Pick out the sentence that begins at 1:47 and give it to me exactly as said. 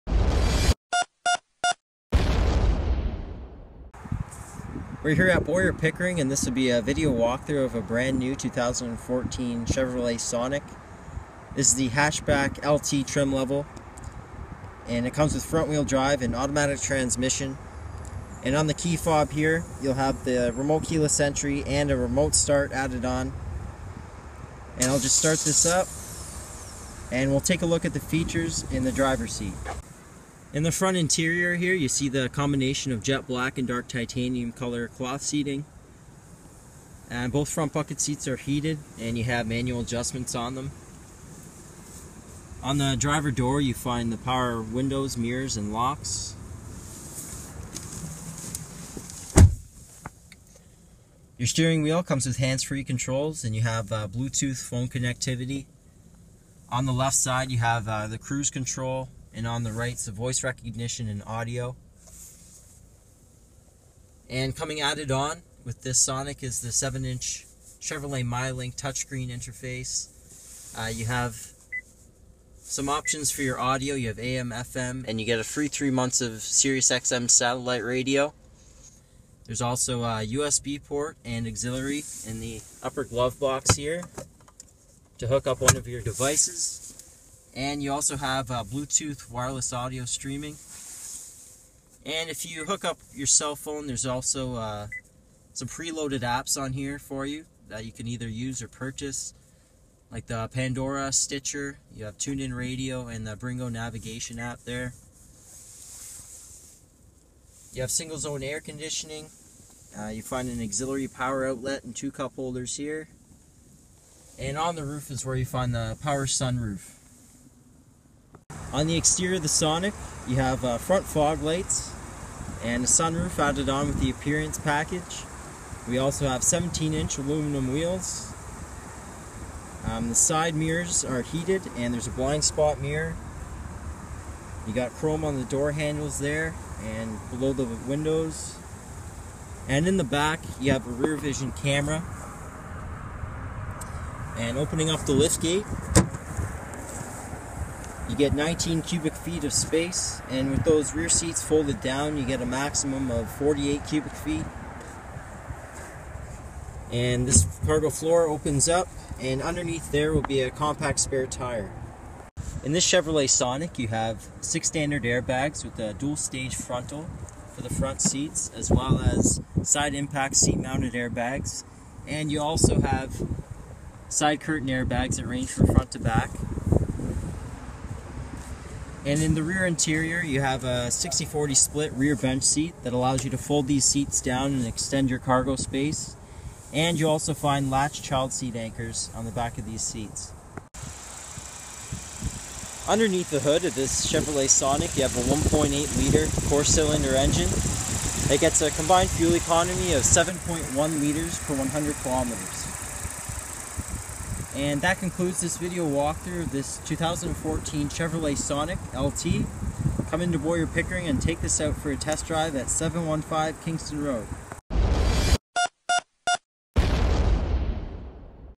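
You have single zone air conditioning.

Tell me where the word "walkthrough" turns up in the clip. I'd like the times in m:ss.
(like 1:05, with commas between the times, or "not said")
0:07, 3:25.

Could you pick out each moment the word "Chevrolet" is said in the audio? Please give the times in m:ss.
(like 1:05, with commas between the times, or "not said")
0:09, 1:07, 2:42, 3:14, 3:27.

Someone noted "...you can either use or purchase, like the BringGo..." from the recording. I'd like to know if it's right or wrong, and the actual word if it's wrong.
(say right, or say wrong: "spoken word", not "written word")
wrong: "Pandora", not "BringGo".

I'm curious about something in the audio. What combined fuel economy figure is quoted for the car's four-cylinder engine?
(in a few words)
7.1 liters per 100 kilometers.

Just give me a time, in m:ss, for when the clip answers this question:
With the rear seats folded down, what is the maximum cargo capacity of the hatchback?
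2:33.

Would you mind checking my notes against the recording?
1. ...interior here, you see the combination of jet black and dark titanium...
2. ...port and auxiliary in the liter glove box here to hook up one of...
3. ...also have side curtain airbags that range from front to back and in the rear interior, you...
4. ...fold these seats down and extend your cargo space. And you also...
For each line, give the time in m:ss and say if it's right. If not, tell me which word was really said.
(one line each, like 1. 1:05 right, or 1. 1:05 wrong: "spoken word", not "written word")
1. 0:30 right
2. 1:20 wrong: "upper", not "liter"
3. 2:52 right
4. 3:03 right.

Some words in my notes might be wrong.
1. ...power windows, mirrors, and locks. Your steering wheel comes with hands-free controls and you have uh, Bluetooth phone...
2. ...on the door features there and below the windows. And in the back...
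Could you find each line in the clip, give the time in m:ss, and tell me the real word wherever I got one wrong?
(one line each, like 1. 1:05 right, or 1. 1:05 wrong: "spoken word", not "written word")
1. 0:44 right
2. 2:15 wrong: "handles", not "features".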